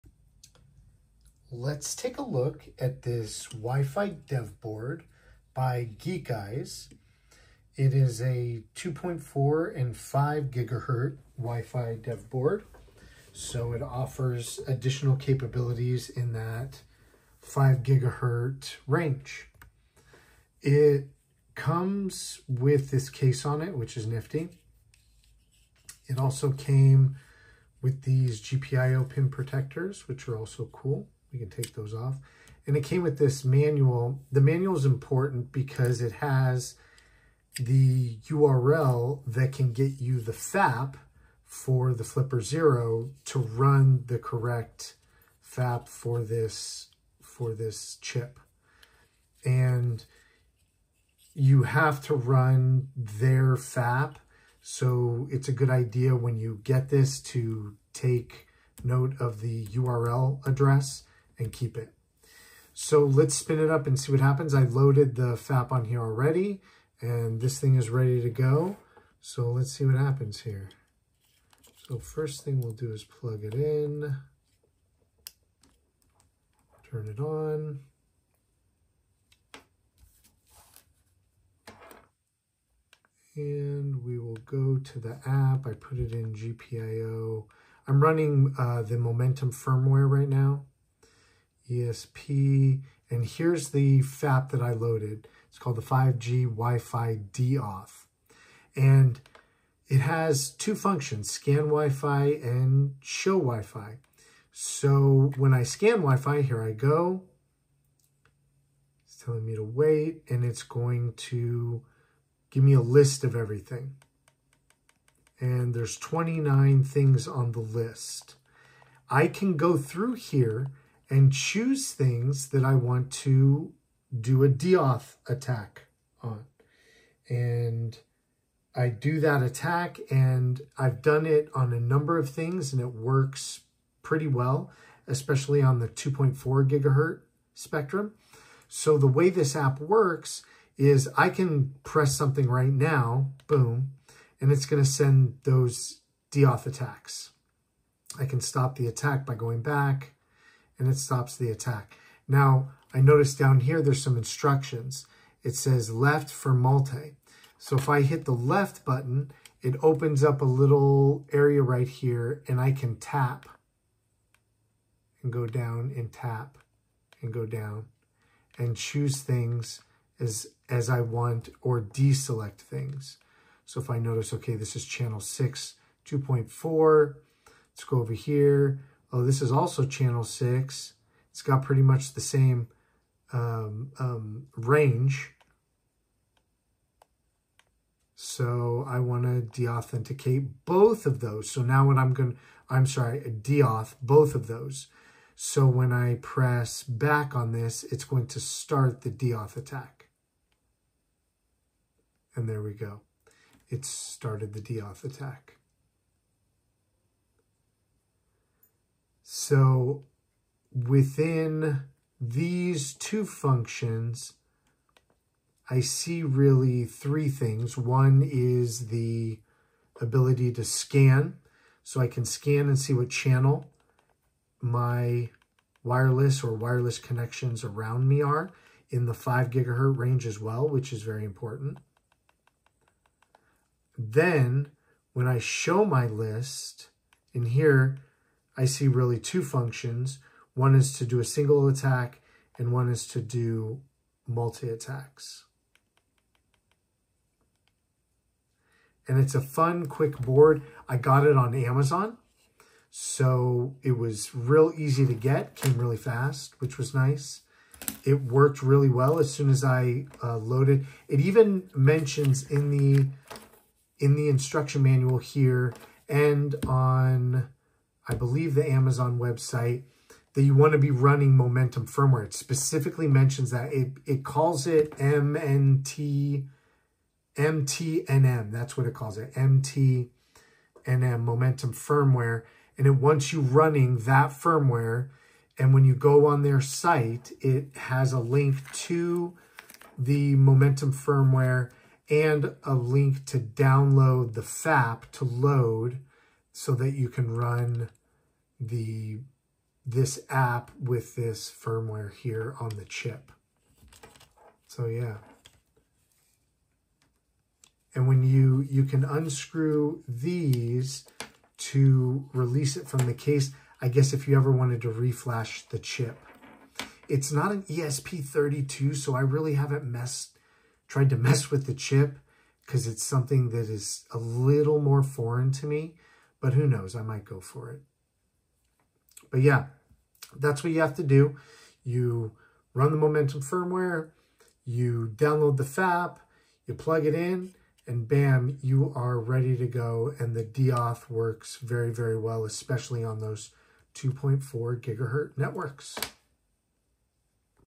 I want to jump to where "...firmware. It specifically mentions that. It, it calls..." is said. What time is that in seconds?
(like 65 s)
271 s.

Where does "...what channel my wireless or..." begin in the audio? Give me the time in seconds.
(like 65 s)
222 s.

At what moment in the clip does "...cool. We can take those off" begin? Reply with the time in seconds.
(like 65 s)
30 s.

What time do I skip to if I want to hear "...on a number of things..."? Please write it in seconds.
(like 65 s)
131 s.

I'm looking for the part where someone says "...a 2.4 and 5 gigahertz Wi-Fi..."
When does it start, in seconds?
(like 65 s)
8 s.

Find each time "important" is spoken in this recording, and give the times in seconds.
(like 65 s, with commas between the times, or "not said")
34 s, 231 s.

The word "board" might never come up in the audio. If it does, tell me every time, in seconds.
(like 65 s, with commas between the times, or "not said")
4 s, 12 s, 250 s.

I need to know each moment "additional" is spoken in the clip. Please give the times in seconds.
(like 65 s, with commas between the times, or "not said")
14 s.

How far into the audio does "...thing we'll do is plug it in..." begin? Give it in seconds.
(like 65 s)
72 s.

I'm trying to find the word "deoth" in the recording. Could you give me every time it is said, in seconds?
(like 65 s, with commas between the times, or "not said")
124 s, 146 s.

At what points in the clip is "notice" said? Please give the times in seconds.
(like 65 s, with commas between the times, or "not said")
153 s, 173 s.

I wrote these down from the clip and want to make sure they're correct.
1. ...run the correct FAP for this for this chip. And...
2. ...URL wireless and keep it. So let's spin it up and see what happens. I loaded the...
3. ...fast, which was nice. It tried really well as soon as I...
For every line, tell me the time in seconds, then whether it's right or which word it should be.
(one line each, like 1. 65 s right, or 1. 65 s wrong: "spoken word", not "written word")
1. 43 s right
2. 59 s wrong: "address", not "wireless"
3. 255 s wrong: "worked", not "tried".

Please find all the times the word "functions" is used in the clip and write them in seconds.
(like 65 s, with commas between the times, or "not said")
100 s, 213 s, 239 s.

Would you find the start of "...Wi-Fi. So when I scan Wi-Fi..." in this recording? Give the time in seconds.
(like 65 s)
103 s.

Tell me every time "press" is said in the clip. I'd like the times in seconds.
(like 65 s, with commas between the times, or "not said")
141 s, 196 s.